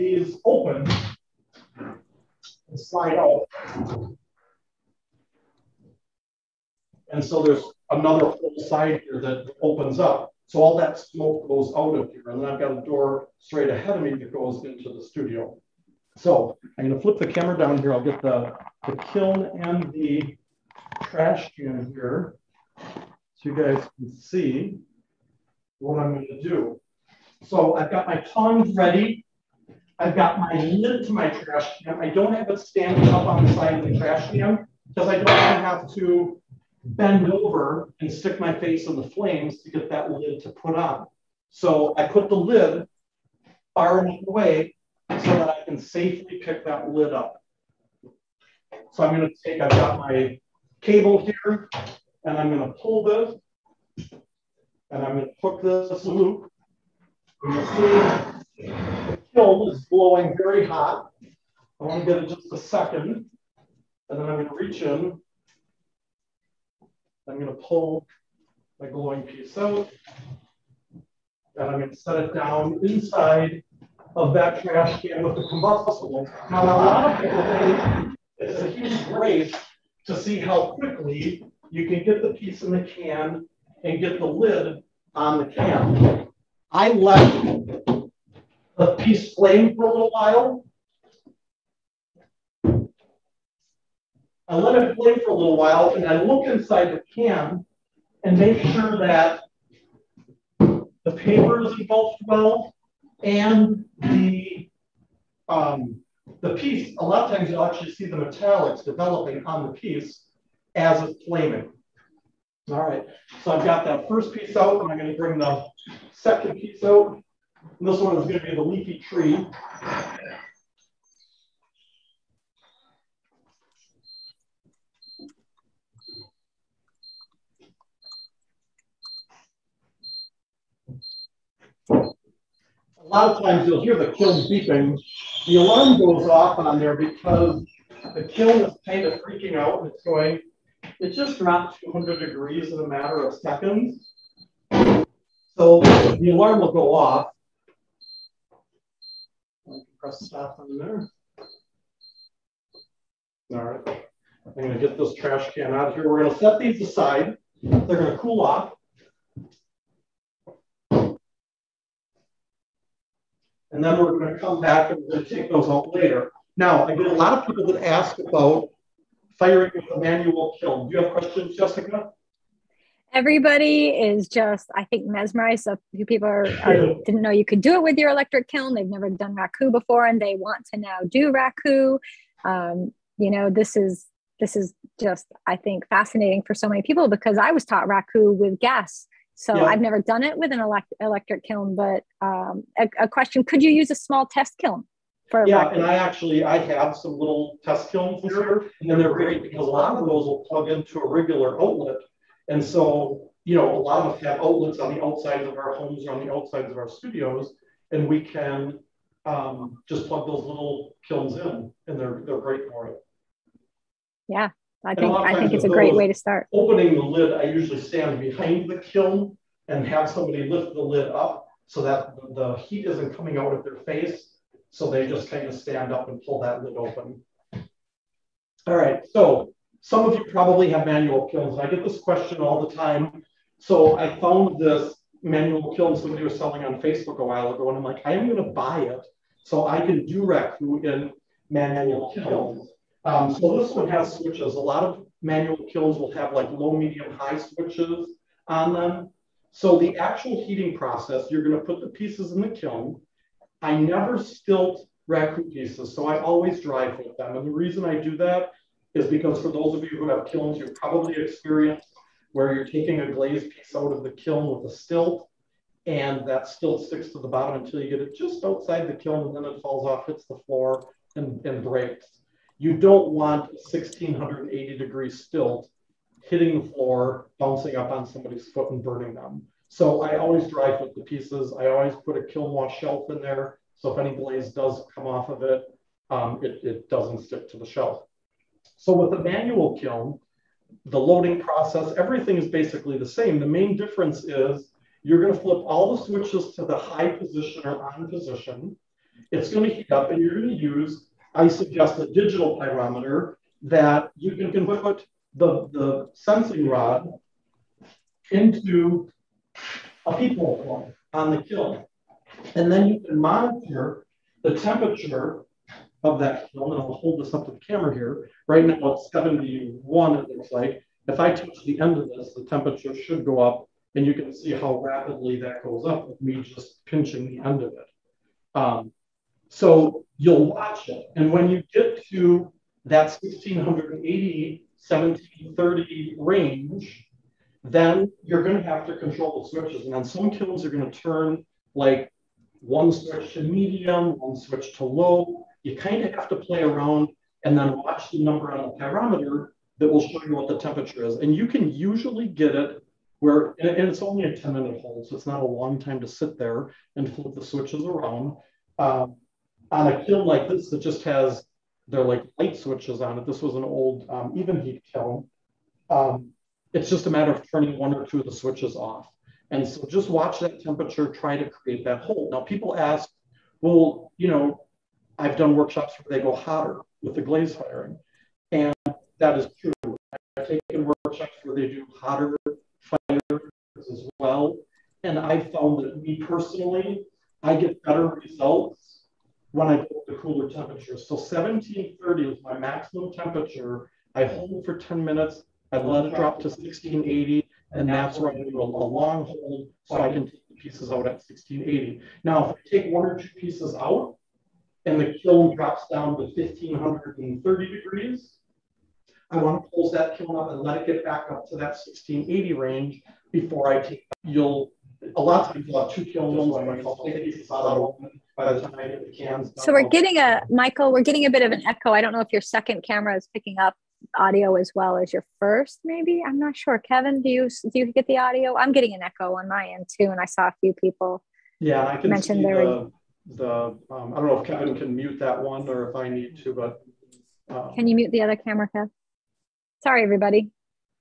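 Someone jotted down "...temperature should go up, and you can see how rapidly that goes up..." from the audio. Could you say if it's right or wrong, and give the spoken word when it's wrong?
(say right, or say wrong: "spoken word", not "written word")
right.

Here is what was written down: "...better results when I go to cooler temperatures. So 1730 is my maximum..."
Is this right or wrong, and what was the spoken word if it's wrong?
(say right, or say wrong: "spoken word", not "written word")
right.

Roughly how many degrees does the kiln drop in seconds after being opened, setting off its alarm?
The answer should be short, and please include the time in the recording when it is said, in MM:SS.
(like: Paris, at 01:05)
200, at 02:21.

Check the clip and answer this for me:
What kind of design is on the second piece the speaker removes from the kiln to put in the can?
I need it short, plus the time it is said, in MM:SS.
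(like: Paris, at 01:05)
Leafy tree, at 01:58.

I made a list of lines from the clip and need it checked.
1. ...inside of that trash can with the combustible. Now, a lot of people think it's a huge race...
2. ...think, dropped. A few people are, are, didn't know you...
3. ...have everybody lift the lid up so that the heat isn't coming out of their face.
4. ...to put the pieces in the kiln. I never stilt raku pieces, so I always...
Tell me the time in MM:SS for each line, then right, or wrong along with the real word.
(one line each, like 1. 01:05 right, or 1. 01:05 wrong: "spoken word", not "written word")
1. 01:12 right
2. 02:54 wrong: "mesmerized", not "dropped"
3. 03:39 wrong: "somebody", not "everybody"
4. 04:11 right.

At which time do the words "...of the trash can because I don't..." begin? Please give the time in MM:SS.
00:33.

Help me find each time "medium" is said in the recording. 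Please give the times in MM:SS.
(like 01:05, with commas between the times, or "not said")
04:06, 05:43.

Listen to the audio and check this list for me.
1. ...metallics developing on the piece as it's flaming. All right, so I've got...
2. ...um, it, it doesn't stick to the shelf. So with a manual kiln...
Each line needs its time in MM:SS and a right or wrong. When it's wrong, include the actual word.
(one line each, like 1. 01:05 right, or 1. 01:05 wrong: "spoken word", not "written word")
1. 01:48 right
2. 04:46 right.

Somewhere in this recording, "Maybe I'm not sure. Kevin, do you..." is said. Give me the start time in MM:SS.
07:05.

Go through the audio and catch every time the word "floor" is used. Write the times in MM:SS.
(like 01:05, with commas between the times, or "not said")
04:30, 04:36.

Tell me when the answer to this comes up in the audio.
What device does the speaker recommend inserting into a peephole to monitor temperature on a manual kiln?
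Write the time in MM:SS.
05:02.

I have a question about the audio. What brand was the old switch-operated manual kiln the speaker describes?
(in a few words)
Evenheat.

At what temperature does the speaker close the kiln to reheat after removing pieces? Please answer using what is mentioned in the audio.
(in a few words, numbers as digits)
1530 degrees.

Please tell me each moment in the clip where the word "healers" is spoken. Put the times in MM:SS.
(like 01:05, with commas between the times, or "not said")
not said.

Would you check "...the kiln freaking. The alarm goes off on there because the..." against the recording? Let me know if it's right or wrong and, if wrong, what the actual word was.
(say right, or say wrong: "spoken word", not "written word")
wrong: "beeping", not "freaking".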